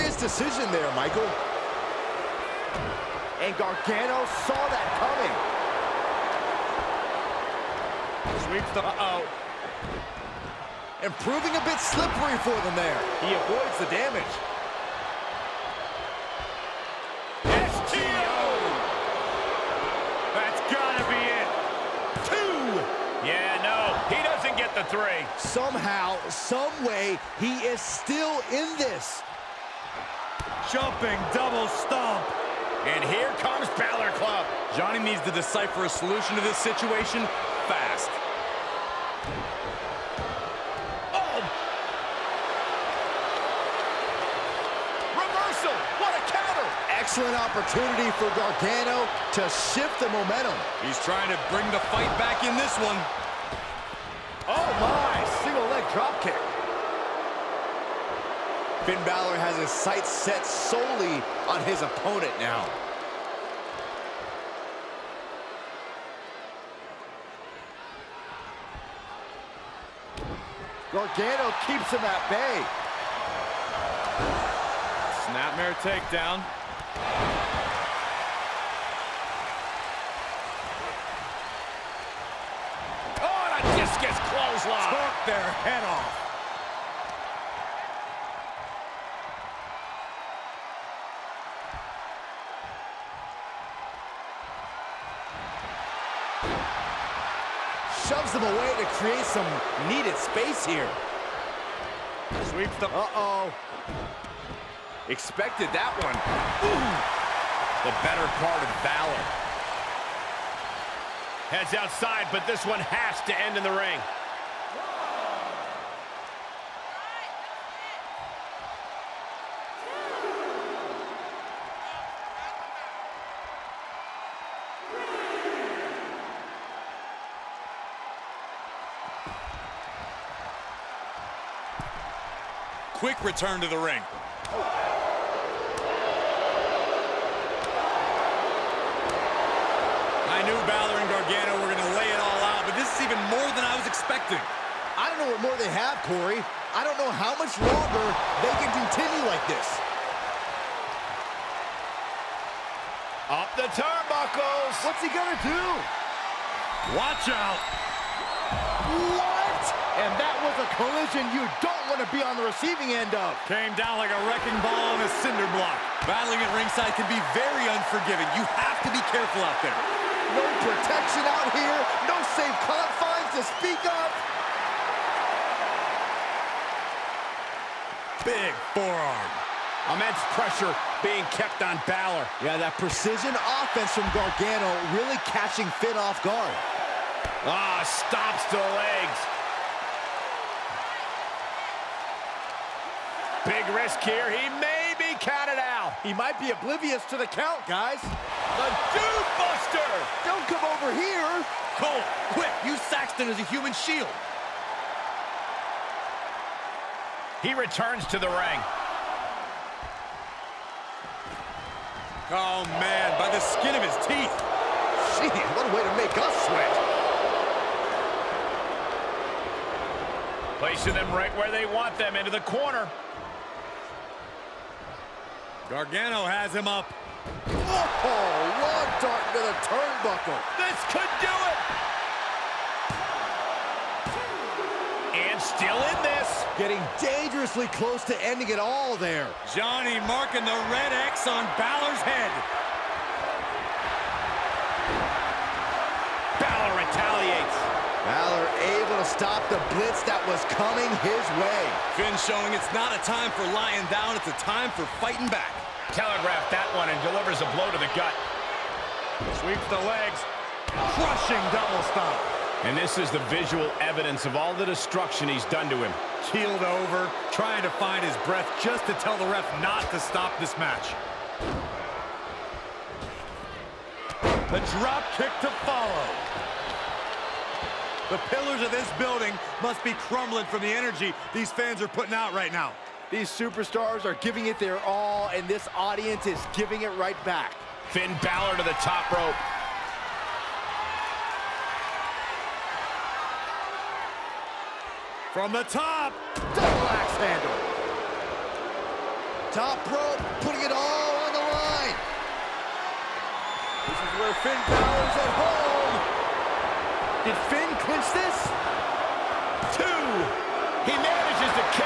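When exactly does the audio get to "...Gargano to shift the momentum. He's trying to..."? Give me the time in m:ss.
0:48.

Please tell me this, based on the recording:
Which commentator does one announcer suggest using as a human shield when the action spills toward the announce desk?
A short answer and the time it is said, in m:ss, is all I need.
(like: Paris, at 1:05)
Saxton, at 3:22.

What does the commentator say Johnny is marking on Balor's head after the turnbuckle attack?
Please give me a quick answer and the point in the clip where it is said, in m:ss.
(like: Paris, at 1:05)
the red X, at 4:00.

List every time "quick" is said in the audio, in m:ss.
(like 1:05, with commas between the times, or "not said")
2:13, 3:22.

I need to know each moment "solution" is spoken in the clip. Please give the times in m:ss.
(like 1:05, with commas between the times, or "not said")
0:35.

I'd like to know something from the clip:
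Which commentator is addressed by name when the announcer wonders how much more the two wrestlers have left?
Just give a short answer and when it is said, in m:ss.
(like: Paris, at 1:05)
Corey, at 2:26.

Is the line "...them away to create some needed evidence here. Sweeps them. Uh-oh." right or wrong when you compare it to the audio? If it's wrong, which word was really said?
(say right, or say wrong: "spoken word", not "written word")
wrong: "space", not "evidence".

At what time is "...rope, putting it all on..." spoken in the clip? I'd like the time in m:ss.
4:59.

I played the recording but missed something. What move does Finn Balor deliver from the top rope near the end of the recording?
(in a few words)
Double axe handle.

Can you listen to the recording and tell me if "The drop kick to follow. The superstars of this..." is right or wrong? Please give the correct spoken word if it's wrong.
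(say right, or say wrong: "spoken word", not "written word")
wrong: "pillars", not "superstars".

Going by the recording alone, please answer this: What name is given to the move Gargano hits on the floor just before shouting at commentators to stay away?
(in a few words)
The Dude Buster.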